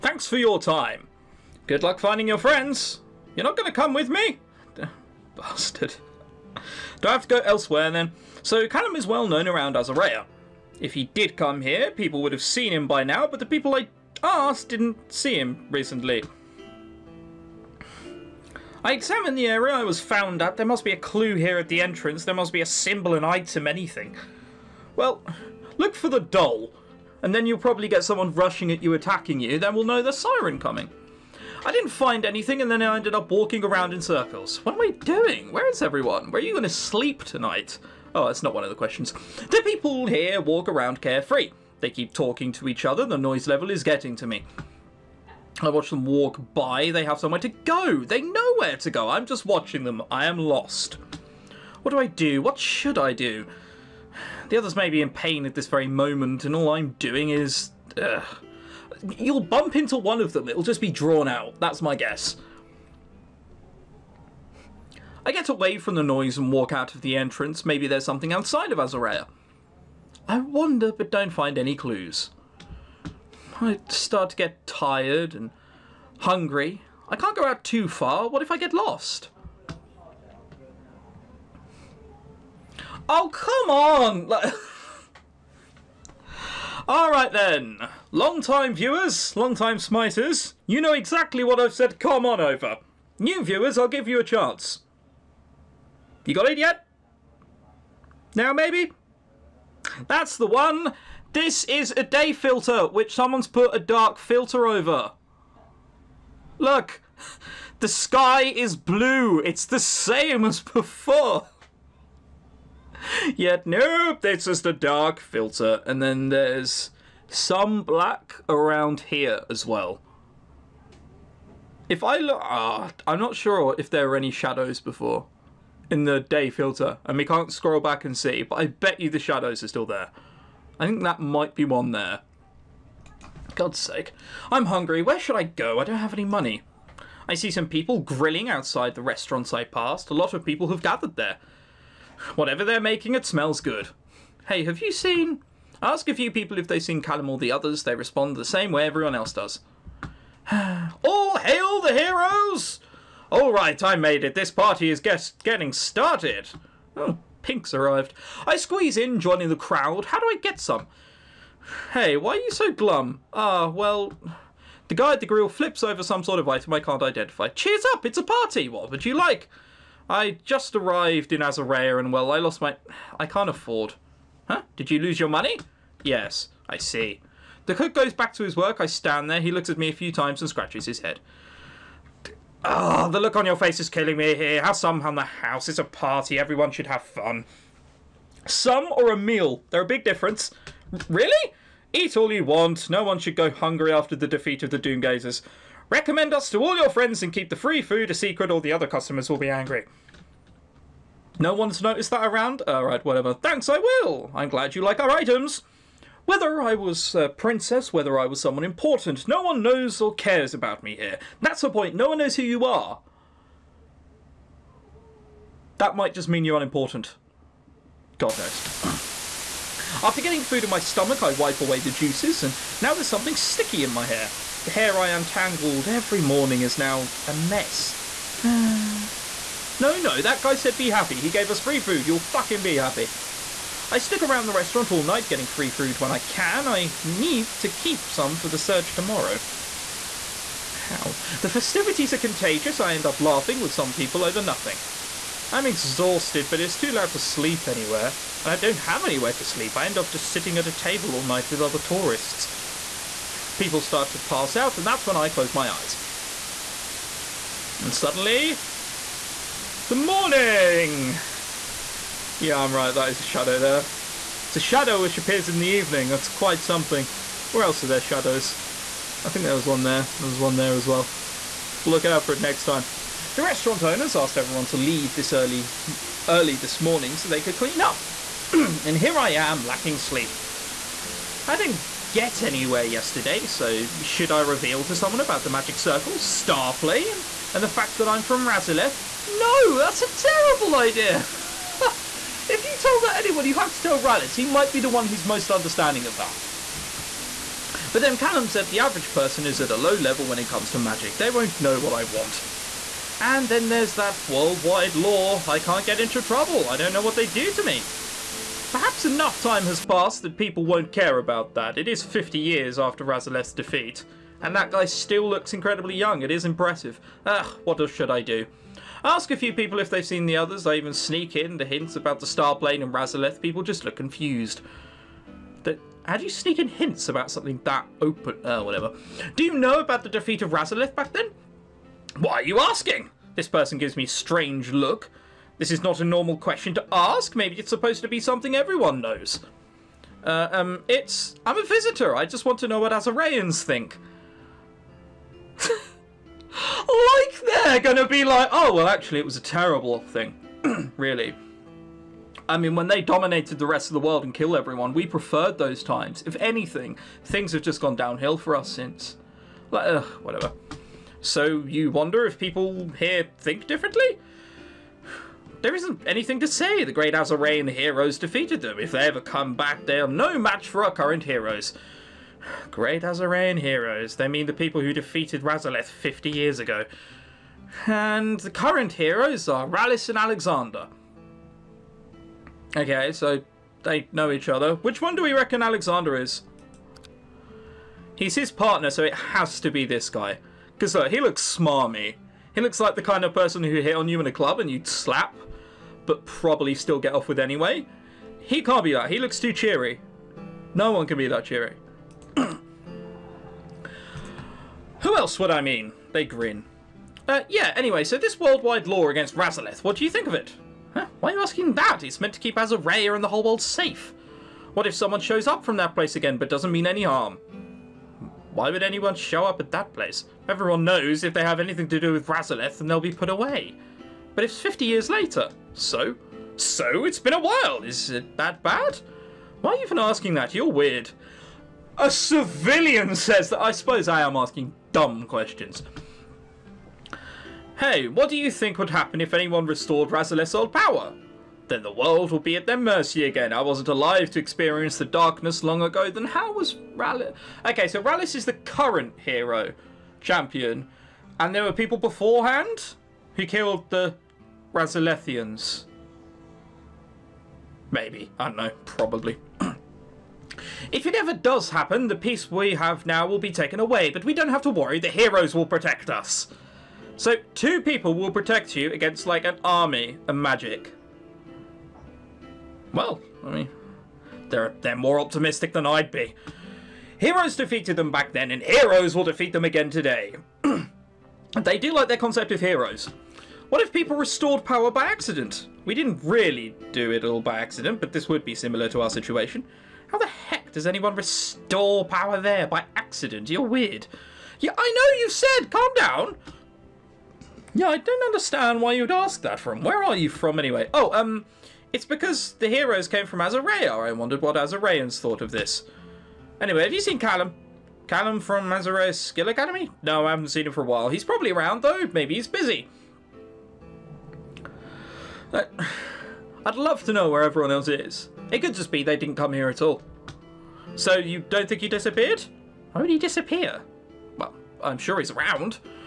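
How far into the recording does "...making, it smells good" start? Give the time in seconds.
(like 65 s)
142 s.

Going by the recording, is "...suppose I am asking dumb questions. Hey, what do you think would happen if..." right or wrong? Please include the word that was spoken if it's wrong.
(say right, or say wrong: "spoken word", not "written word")
right.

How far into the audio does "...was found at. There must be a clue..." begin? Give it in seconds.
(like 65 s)
19 s.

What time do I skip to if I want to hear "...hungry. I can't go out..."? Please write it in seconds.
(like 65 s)
76 s.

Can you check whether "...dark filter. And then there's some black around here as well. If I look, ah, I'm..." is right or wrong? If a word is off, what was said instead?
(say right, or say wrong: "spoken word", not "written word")
right.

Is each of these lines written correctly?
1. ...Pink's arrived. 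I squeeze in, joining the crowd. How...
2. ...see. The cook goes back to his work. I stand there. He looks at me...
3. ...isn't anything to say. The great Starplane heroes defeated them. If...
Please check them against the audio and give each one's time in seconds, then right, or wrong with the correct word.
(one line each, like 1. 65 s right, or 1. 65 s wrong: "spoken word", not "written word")
1. 157 s right
2. 176 s right
3. 365 s wrong: "Azarae", not "Starplane".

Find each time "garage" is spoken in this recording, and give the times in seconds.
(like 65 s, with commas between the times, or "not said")
not said.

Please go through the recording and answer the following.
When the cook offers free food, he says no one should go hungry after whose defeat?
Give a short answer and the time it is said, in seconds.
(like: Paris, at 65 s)
the Doomgazers, at 194 s.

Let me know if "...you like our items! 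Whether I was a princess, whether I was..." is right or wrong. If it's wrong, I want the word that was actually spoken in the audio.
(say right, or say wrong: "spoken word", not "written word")
right.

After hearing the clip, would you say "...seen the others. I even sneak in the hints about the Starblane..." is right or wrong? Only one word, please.
right.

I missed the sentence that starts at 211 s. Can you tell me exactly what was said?
That's the point, no one knows who you are.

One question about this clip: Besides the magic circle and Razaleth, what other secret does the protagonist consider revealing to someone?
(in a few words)
Starplane.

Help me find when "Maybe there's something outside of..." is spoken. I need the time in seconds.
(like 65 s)
67 s.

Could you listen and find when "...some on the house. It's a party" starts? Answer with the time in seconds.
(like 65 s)
184 s.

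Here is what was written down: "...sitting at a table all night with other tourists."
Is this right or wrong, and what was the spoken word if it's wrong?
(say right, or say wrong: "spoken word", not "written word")
right.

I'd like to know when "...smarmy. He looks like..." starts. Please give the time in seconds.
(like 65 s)
391 s.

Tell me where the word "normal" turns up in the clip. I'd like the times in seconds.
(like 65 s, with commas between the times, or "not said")
336 s.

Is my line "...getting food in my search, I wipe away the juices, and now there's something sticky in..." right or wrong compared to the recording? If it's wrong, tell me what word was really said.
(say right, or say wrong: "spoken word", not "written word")
wrong: "stomach", not "search".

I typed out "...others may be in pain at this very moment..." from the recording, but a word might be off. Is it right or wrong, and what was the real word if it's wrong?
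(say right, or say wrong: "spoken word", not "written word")
right.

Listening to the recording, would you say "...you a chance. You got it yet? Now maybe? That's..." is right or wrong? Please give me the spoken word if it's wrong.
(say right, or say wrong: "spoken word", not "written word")
right.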